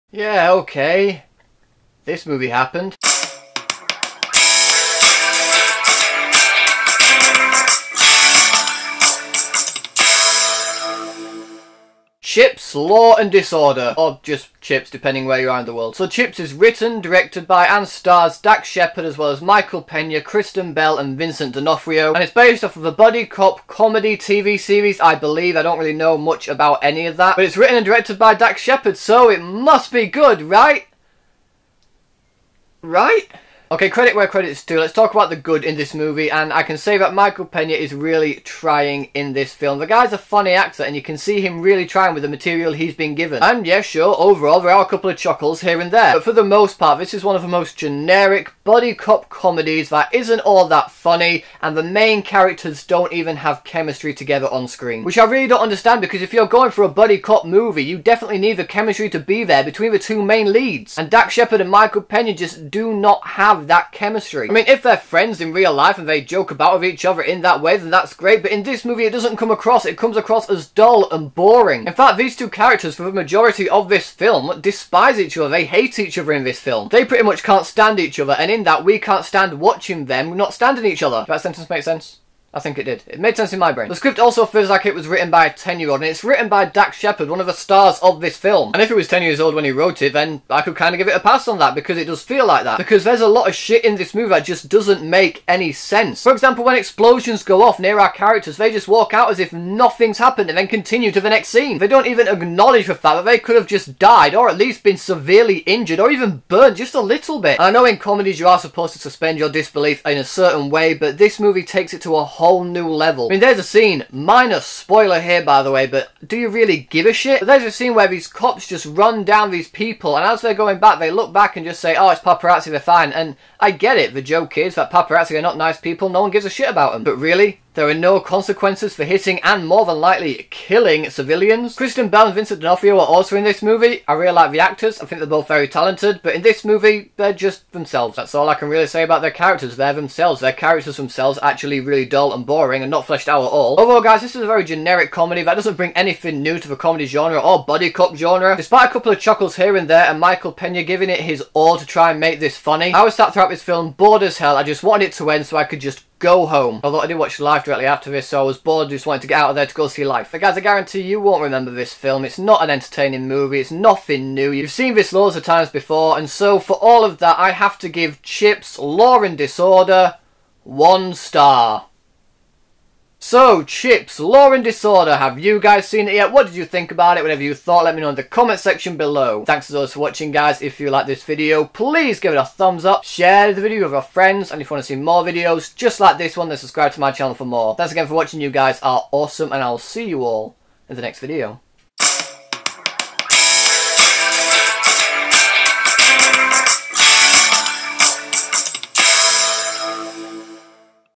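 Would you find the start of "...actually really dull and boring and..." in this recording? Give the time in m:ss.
2:21.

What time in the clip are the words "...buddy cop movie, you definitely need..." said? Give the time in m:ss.
0:56.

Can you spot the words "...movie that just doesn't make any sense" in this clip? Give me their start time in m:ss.
1:34.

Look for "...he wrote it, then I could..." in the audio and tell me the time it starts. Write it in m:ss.
1:29.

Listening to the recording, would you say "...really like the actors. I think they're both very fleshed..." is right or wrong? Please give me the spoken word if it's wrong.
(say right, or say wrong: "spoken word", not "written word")
wrong: "talented", not "fleshed".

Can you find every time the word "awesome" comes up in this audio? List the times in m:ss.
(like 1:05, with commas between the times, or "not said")
3:09.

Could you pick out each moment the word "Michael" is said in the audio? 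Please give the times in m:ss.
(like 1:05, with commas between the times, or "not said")
0:19, 0:37, 1:01, 2:30.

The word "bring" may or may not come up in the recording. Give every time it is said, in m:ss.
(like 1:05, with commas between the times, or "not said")
2:25.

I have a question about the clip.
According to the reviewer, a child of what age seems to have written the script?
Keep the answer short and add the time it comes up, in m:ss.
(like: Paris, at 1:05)
10, at 1:25.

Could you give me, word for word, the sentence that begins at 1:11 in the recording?
In fact, these two characters, for the majority of this film, despise each other.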